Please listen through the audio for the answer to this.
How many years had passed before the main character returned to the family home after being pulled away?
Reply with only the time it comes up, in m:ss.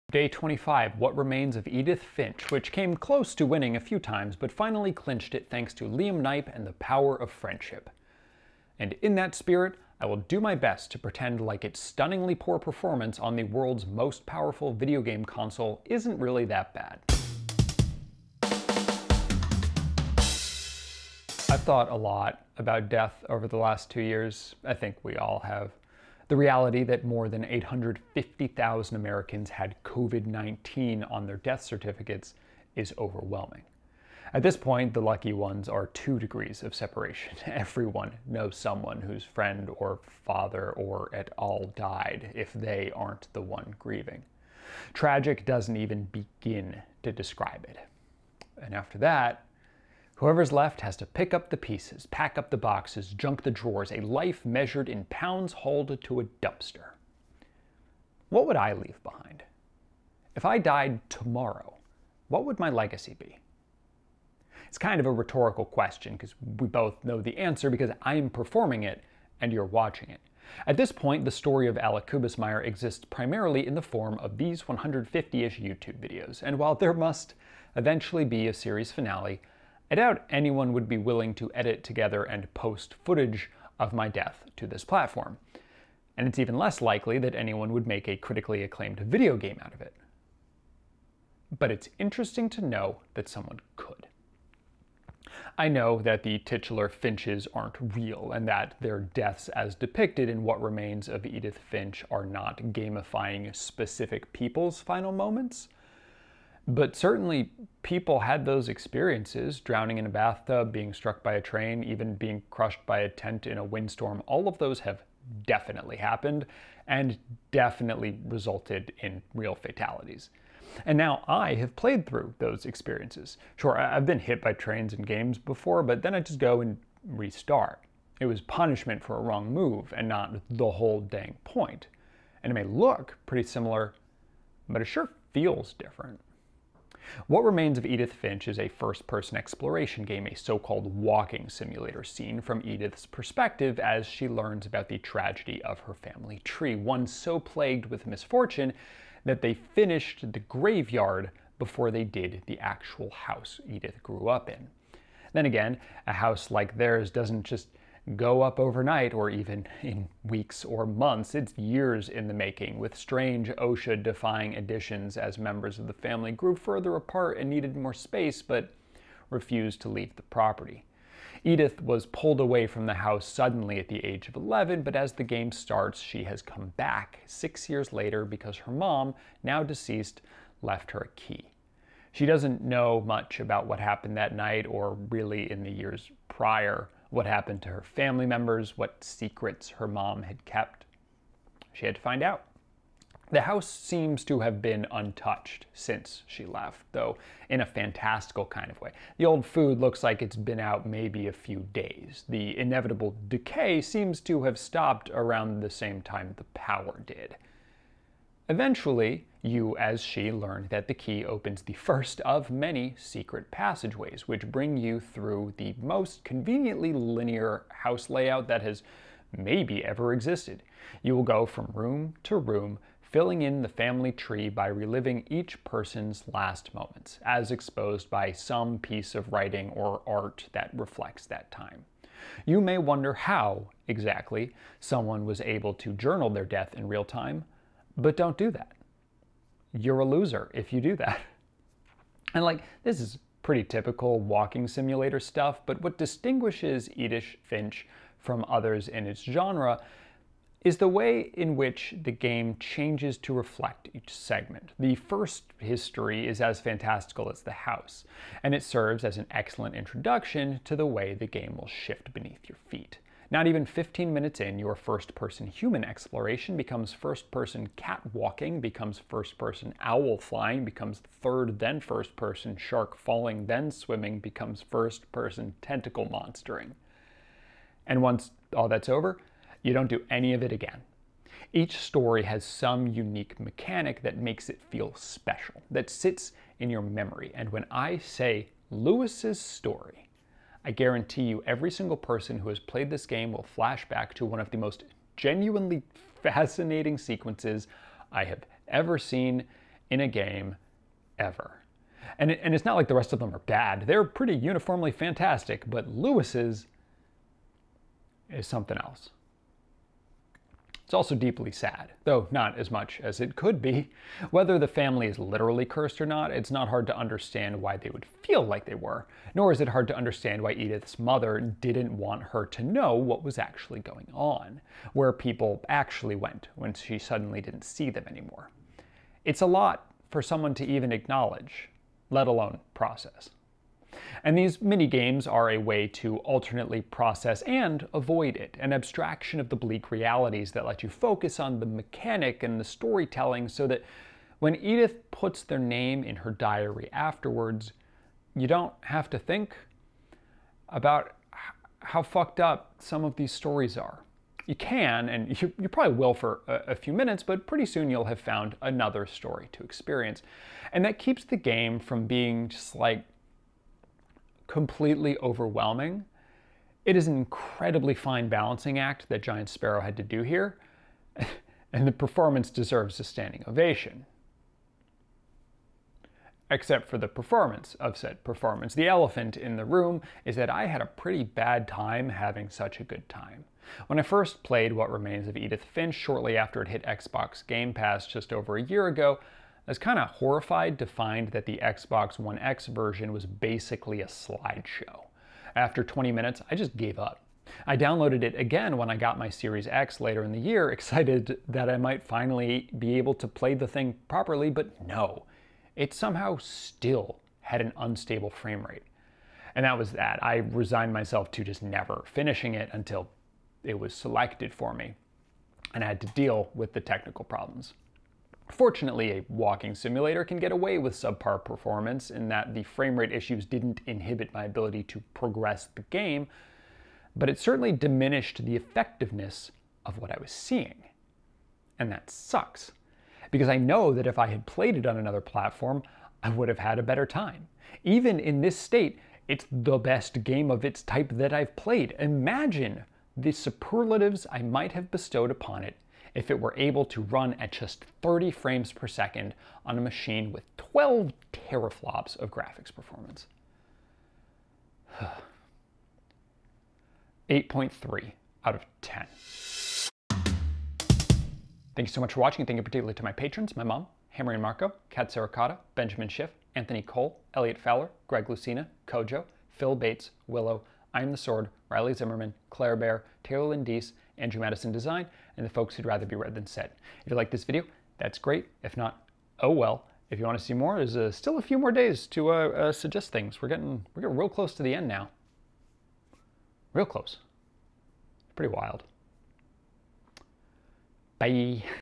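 2:57.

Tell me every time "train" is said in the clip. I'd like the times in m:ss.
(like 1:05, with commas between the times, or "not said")
1:51, 2:04.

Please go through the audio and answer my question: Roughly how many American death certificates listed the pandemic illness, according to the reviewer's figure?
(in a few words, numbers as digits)
850,000.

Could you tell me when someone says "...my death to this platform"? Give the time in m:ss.
1:23.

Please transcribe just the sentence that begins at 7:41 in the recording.
Thank you so much for watching.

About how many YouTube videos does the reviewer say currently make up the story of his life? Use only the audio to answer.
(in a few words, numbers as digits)
150-ish.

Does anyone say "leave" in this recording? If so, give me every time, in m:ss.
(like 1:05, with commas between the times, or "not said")
0:58, 2:49.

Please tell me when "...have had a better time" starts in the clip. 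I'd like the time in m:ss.
7:16.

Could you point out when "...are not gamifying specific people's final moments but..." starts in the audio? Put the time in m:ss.
1:42.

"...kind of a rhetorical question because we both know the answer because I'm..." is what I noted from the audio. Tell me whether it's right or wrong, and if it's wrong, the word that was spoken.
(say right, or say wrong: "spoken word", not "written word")
right.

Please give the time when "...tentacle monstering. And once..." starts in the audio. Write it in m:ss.
4:35.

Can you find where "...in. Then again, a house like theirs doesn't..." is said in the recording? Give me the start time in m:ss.
2:34.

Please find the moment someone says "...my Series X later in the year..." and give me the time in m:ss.
6:39.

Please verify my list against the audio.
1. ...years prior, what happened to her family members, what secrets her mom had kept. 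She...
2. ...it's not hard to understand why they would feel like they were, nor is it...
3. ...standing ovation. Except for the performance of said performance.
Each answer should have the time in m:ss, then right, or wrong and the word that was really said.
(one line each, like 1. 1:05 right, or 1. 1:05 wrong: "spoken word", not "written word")
1. 3:05 right
2. 5:16 right
3. 6:13 right.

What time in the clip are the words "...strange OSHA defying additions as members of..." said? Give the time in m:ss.
2:42.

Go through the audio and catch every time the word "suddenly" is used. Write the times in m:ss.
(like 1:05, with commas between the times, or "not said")
2:53, 5:26.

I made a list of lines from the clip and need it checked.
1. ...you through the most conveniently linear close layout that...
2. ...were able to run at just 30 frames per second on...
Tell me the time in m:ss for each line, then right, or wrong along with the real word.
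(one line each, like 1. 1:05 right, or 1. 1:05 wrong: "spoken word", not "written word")
1. 3:34 wrong: "house", not "close"
2. 7:26 right.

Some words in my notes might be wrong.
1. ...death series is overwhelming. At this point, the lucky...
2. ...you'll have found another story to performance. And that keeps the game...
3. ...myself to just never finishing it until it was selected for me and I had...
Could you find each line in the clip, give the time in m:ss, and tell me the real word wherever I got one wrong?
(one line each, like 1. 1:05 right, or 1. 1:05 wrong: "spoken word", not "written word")
1. 0:31 wrong: "certificates", not "series"
2. 5:57 wrong: "experience", not "performance"
3. 6:50 right.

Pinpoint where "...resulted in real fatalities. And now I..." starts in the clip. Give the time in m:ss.
1:58.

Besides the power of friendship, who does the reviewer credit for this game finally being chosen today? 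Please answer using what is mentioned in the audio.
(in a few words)
Liam Knipe.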